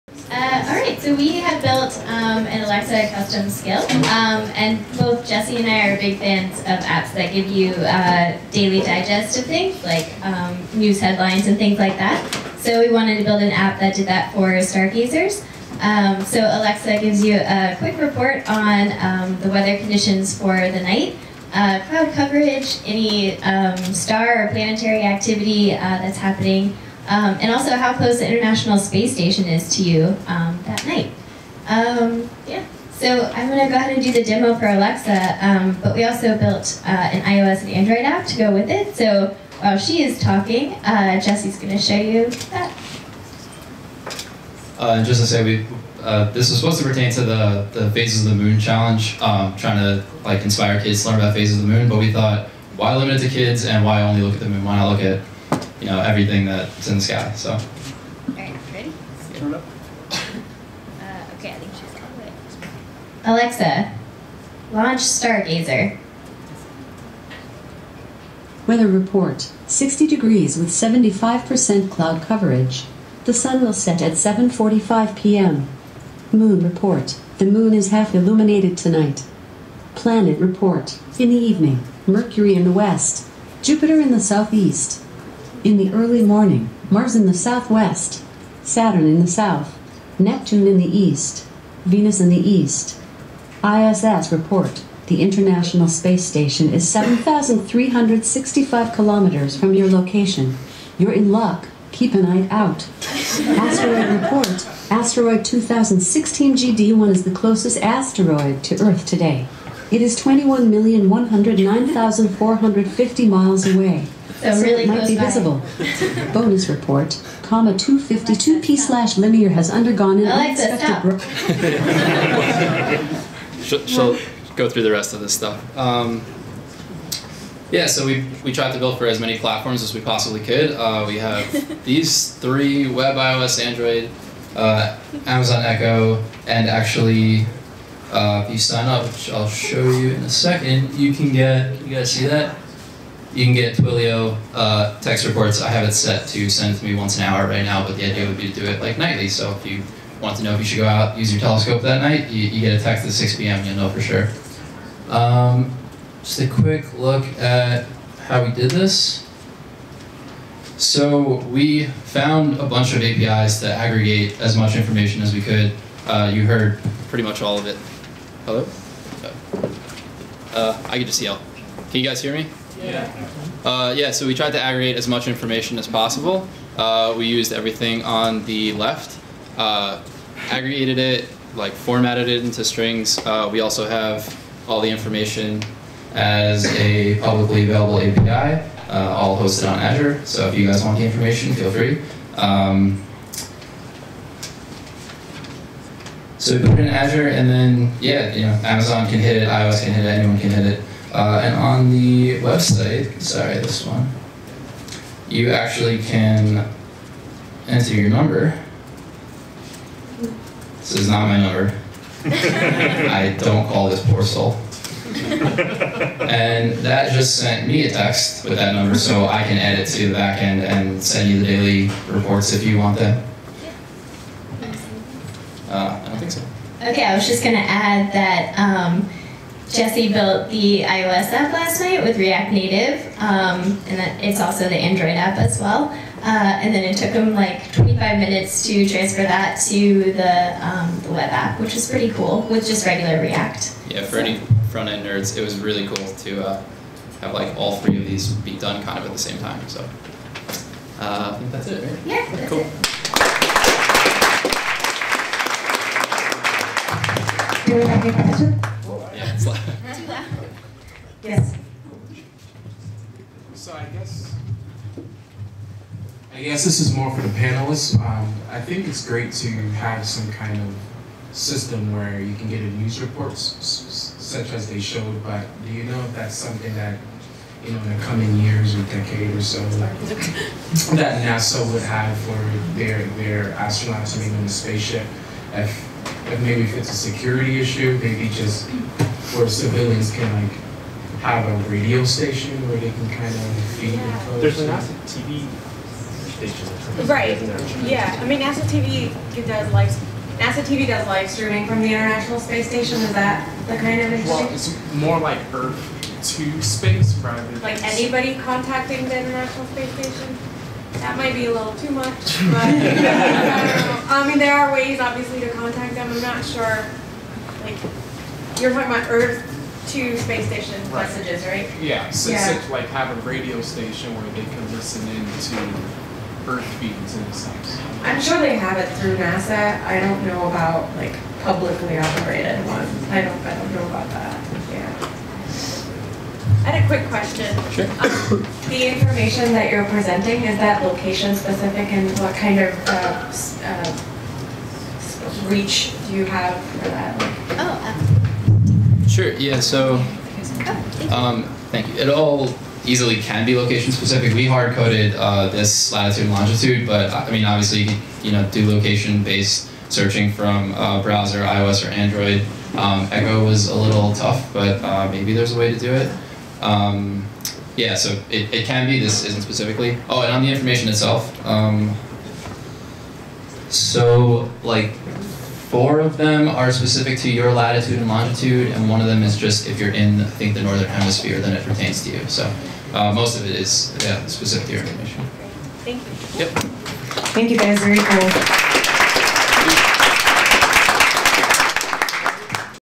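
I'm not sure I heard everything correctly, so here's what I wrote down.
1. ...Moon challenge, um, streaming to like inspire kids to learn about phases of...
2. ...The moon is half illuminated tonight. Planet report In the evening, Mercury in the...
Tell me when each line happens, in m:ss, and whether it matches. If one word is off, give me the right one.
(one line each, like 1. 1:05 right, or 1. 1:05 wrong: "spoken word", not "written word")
1. 0:48 wrong: "trying", not "streaming"
2. 1:17 right.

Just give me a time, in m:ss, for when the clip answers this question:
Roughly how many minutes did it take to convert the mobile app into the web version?
3:57.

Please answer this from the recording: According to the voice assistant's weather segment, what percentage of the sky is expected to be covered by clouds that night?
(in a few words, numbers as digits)
75%.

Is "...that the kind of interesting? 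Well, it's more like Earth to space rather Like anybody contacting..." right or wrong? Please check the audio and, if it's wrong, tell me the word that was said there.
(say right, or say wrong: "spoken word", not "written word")
right.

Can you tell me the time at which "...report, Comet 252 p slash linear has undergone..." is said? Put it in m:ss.
1:56.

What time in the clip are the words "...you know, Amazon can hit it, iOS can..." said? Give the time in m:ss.
3:18.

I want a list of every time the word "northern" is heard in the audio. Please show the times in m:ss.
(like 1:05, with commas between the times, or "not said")
6:20.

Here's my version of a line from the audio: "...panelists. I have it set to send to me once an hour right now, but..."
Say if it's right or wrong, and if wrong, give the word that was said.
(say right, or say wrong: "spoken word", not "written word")
wrong: "reports", not "panelists".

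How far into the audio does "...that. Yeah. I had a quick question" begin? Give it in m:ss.
5:34.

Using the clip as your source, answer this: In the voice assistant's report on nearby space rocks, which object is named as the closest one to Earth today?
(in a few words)
2016 GD1.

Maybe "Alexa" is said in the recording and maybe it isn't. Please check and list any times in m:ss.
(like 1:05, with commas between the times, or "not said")
0:02, 0:16, 0:34, 1:03.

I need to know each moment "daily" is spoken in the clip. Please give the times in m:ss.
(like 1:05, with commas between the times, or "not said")
0:08, 3:41.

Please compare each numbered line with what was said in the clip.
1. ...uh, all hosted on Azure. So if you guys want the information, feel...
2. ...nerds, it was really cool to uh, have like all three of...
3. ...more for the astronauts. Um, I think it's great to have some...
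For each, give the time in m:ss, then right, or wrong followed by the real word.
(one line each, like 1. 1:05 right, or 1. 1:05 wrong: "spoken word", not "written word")
1. 3:08 right
2. 4:05 right
3. 4:26 wrong: "panelists", not "astronauts".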